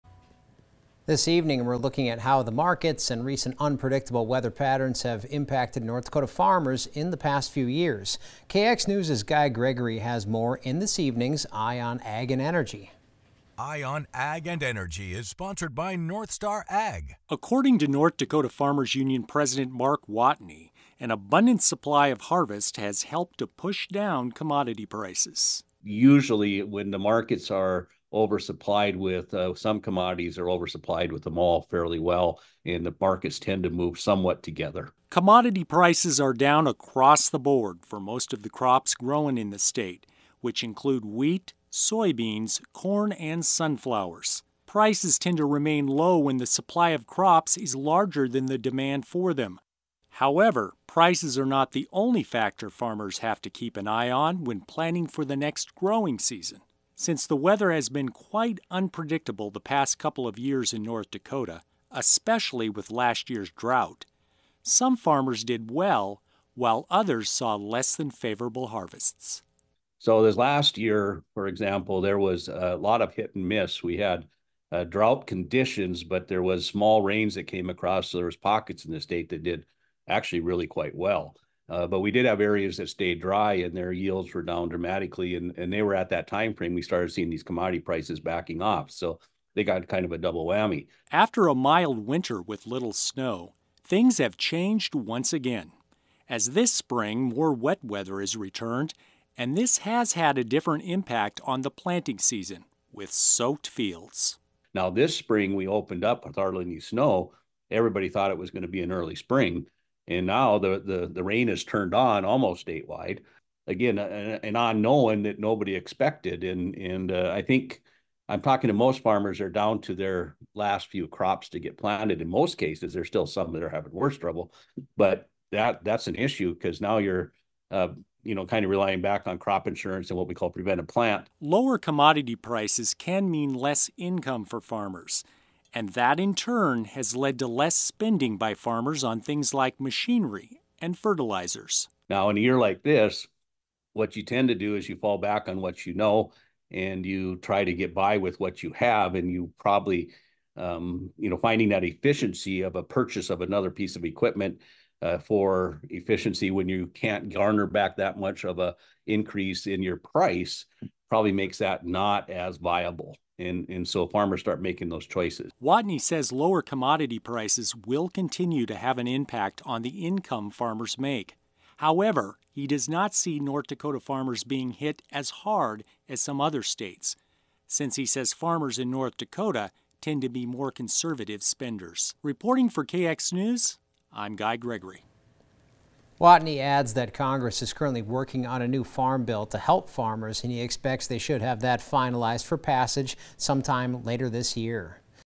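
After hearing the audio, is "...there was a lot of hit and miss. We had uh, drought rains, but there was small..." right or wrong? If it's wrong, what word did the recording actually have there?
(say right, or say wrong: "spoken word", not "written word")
wrong: "conditions", not "rains".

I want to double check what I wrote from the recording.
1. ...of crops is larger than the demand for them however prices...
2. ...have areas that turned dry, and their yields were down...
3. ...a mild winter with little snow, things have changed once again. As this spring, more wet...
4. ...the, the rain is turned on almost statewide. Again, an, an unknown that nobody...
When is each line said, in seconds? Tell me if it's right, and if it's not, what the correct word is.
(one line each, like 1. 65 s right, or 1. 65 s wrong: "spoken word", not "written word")
1. 46 s right
2. 82 s wrong: "stayed", not "turned"
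3. 91 s right
4. 110 s right.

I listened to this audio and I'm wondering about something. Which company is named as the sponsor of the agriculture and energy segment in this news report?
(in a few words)
North Star Ag.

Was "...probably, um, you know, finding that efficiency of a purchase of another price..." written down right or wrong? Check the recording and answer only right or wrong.
wrong.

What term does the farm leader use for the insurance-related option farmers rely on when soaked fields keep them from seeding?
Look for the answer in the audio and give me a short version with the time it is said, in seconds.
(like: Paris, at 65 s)
preventive plant, at 130 s.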